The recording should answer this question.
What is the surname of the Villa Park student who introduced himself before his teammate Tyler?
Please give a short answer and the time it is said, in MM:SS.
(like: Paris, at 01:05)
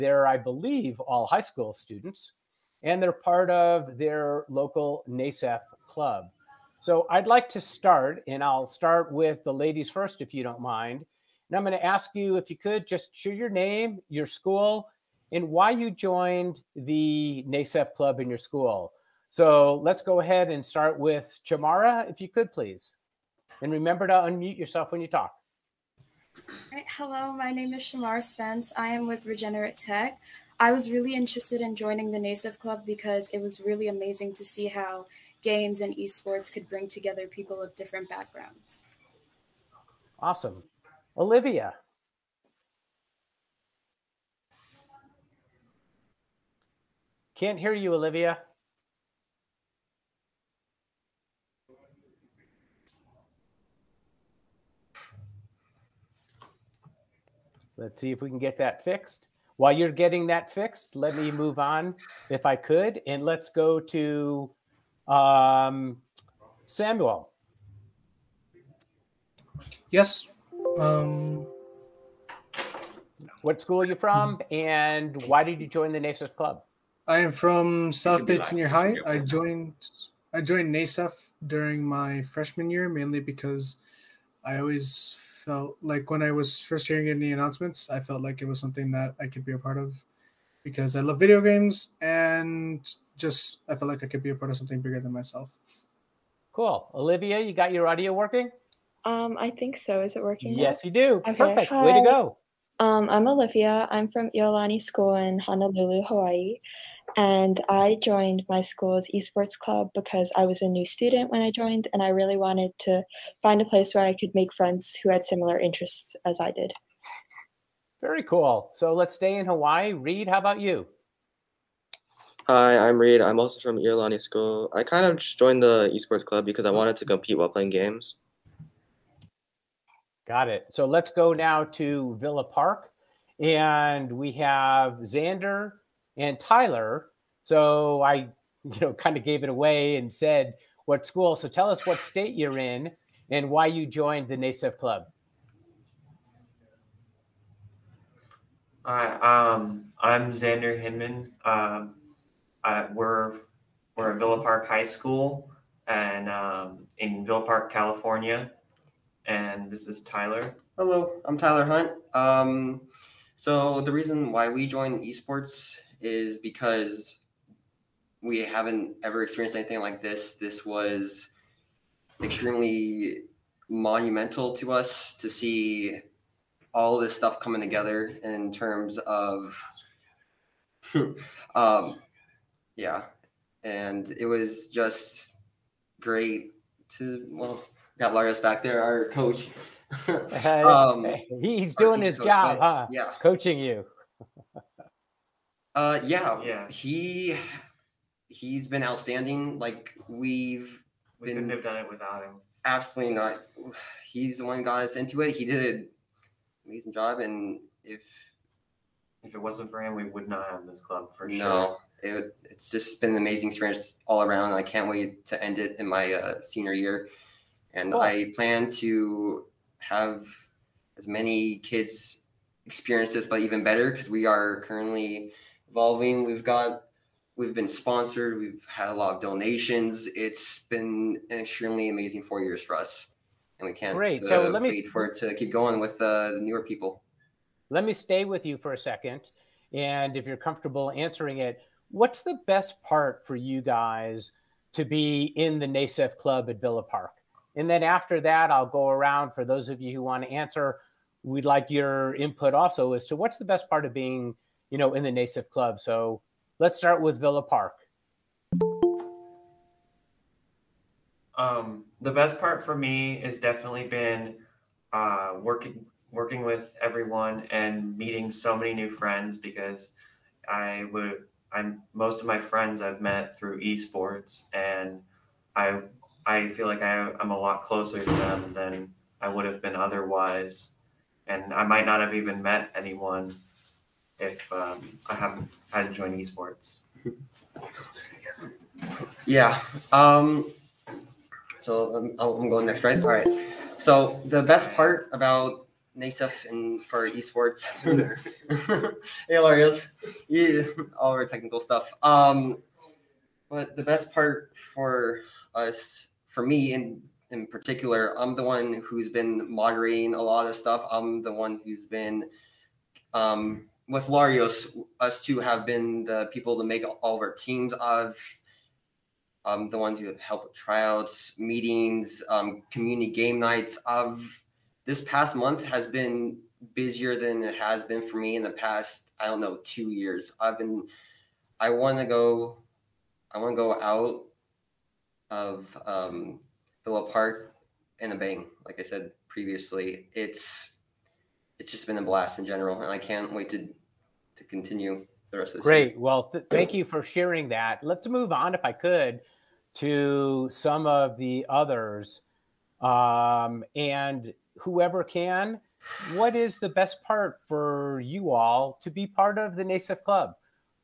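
Hinman, at 02:30.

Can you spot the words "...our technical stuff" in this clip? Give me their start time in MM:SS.
05:01.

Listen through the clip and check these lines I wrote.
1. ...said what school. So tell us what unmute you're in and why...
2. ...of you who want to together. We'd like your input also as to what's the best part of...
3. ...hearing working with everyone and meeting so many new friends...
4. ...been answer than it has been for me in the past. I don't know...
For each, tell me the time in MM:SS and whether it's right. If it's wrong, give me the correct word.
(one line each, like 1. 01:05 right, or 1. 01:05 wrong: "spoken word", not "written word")
1. 02:20 wrong: "state", not "unmute"
2. 04:09 wrong: "answer", not "together"
3. 04:25 wrong: "working", not "hearing"
4. 05:25 wrong: "busier", not "answer".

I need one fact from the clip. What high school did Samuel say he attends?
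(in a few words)
South Bay Senior High.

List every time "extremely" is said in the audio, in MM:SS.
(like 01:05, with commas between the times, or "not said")
02:52, 03:51.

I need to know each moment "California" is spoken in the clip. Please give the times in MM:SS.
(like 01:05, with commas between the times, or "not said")
02:37.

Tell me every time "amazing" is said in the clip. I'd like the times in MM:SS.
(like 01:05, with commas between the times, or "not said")
00:33, 03:26, 03:33, 03:51.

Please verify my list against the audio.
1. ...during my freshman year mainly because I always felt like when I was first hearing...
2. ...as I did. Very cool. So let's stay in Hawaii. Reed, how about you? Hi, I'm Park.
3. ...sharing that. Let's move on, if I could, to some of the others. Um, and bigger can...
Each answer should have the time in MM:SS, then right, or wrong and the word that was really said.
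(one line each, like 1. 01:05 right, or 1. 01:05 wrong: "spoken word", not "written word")
1. 01:21 right
2. 01:56 wrong: "Reed", not "Park"
3. 05:47 wrong: "whoever", not "bigger".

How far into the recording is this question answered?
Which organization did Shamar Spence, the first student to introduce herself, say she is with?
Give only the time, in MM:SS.
00:29.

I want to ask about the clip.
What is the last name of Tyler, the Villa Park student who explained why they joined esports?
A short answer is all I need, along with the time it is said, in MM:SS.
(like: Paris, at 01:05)
Hunt, at 02:41.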